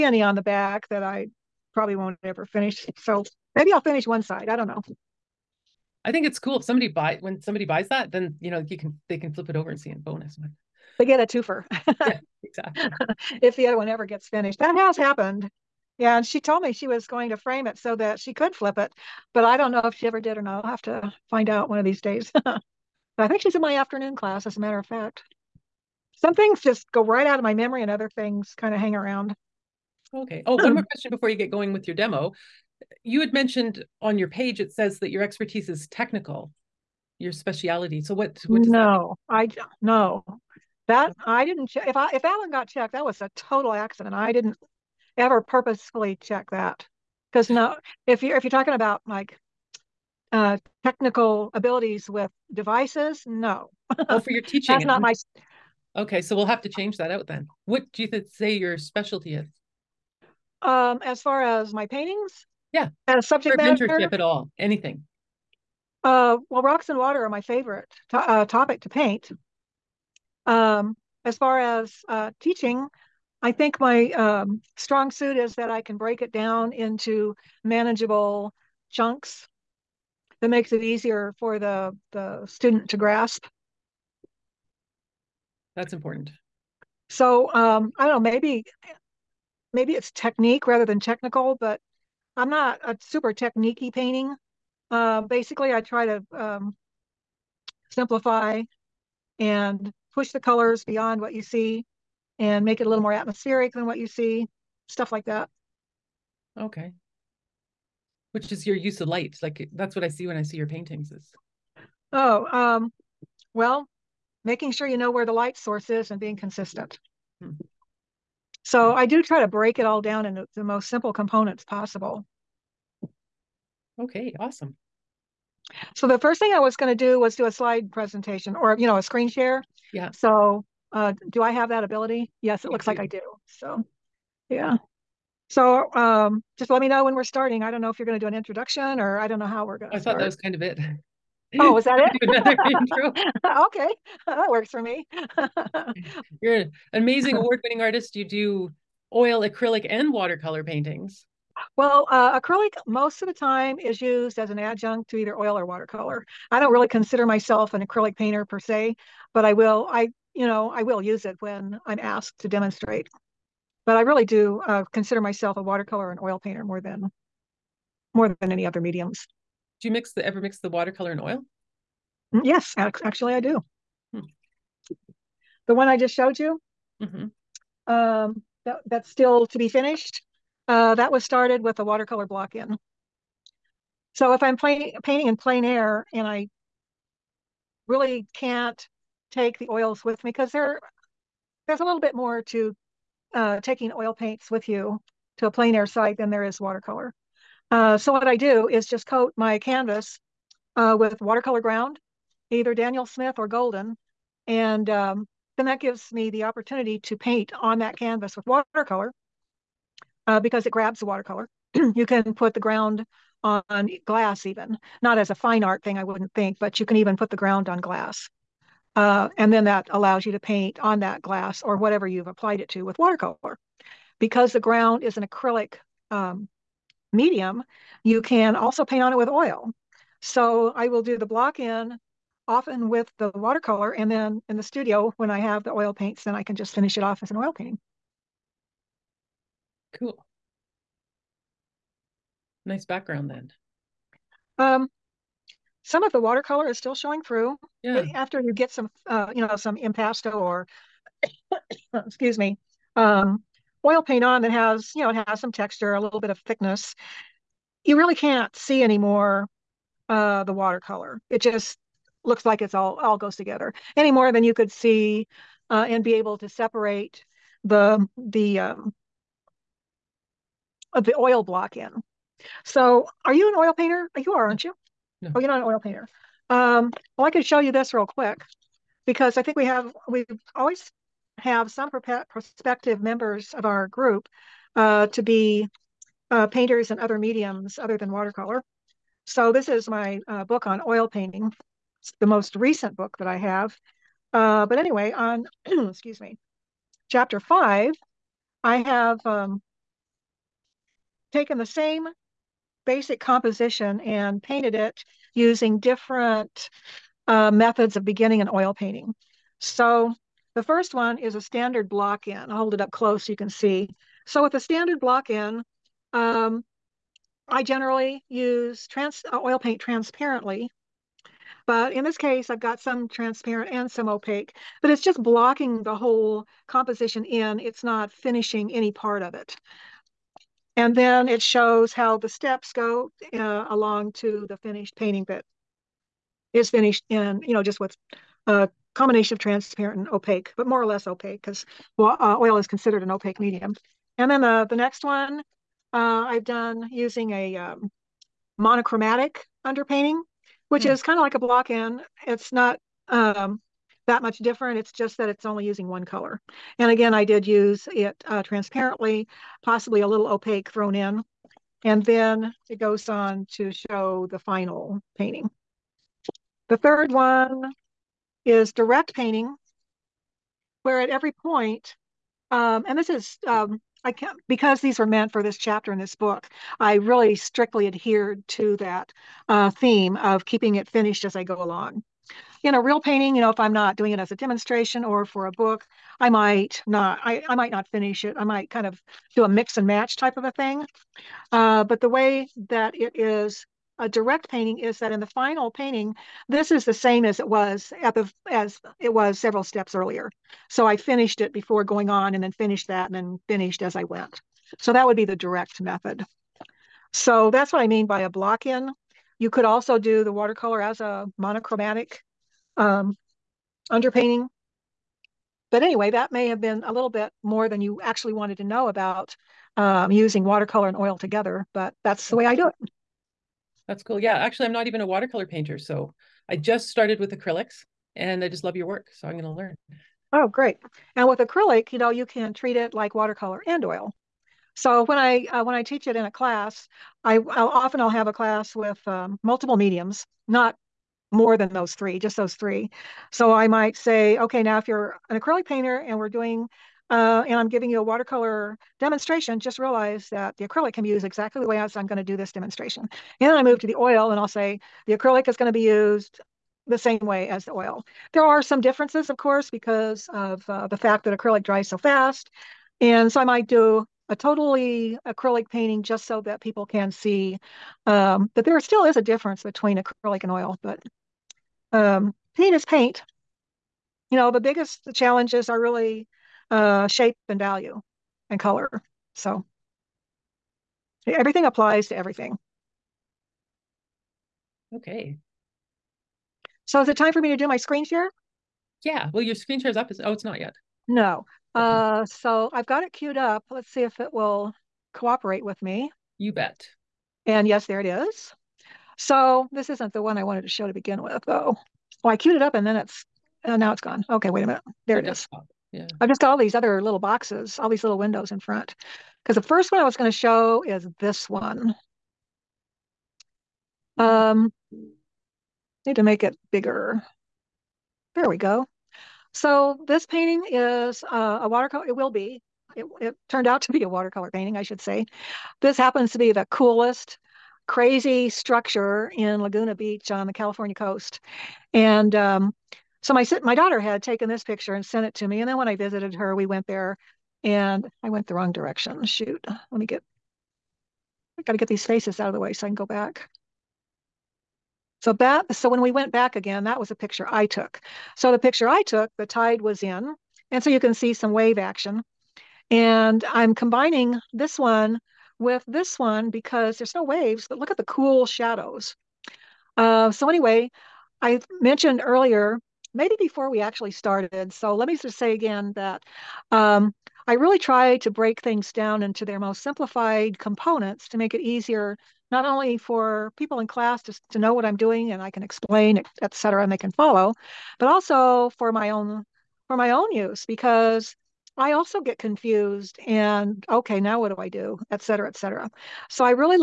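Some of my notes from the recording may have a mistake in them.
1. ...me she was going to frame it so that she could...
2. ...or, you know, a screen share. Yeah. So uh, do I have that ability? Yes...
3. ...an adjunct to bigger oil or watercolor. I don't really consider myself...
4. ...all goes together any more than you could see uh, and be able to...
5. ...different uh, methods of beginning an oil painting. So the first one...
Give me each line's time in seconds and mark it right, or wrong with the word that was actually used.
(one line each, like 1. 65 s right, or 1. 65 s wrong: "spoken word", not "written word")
1. 16 s right
2. 128 s right
3. 154 s wrong: "either", not "bigger"
4. 262 s right
5. 305 s right.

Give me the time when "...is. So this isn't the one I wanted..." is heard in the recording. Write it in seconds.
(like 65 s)
498 s.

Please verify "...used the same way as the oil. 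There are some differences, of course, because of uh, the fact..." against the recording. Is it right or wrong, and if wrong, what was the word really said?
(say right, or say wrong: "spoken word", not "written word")
right.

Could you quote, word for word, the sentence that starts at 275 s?
Oh, you're not an oil painter.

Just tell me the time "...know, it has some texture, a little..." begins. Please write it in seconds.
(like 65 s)
255 s.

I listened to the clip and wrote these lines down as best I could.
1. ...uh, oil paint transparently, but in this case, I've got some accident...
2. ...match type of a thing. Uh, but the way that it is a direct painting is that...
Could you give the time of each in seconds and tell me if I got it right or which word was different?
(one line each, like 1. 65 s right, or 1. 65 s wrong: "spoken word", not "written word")
1. 319 s wrong: "transparent", not "accident"
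2. 389 s right.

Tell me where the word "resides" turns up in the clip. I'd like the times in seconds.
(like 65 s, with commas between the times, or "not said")
not said.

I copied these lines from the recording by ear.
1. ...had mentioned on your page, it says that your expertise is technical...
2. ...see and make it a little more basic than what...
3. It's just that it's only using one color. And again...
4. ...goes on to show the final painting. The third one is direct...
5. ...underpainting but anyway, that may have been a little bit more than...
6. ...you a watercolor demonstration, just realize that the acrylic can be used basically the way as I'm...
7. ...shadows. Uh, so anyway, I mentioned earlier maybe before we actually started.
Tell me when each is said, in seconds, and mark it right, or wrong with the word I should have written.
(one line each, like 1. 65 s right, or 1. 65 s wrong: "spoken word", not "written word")
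1. 33 s right
2. 101 s wrong: "atmospheric", not "basic"
3. 354 s right
4. 362 s right
5. 413 s right
6. 447 s wrong: "exactly", not "basically"
7. 558 s right.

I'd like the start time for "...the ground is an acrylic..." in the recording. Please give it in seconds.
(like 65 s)
224 s.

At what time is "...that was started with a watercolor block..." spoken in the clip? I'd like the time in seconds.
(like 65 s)
180 s.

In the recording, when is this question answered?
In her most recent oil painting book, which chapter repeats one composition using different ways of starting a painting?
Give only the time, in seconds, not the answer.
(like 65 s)
297 s.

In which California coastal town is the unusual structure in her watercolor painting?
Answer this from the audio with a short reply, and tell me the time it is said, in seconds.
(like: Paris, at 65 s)
Laguna Beach, at 529 s.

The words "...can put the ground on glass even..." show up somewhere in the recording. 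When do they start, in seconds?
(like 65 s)
212 s.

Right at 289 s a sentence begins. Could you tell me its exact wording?
So this is my uh, book on oil painting the most recent book that I have.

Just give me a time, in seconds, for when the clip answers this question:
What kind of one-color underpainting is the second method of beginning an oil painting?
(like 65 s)
348 s.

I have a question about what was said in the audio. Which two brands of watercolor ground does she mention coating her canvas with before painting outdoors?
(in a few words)
Daniel Smith or Golden.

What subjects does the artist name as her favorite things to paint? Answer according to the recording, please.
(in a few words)
Rocks and water.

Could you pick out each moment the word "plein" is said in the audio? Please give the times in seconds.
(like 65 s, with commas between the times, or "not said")
185 s, 195 s.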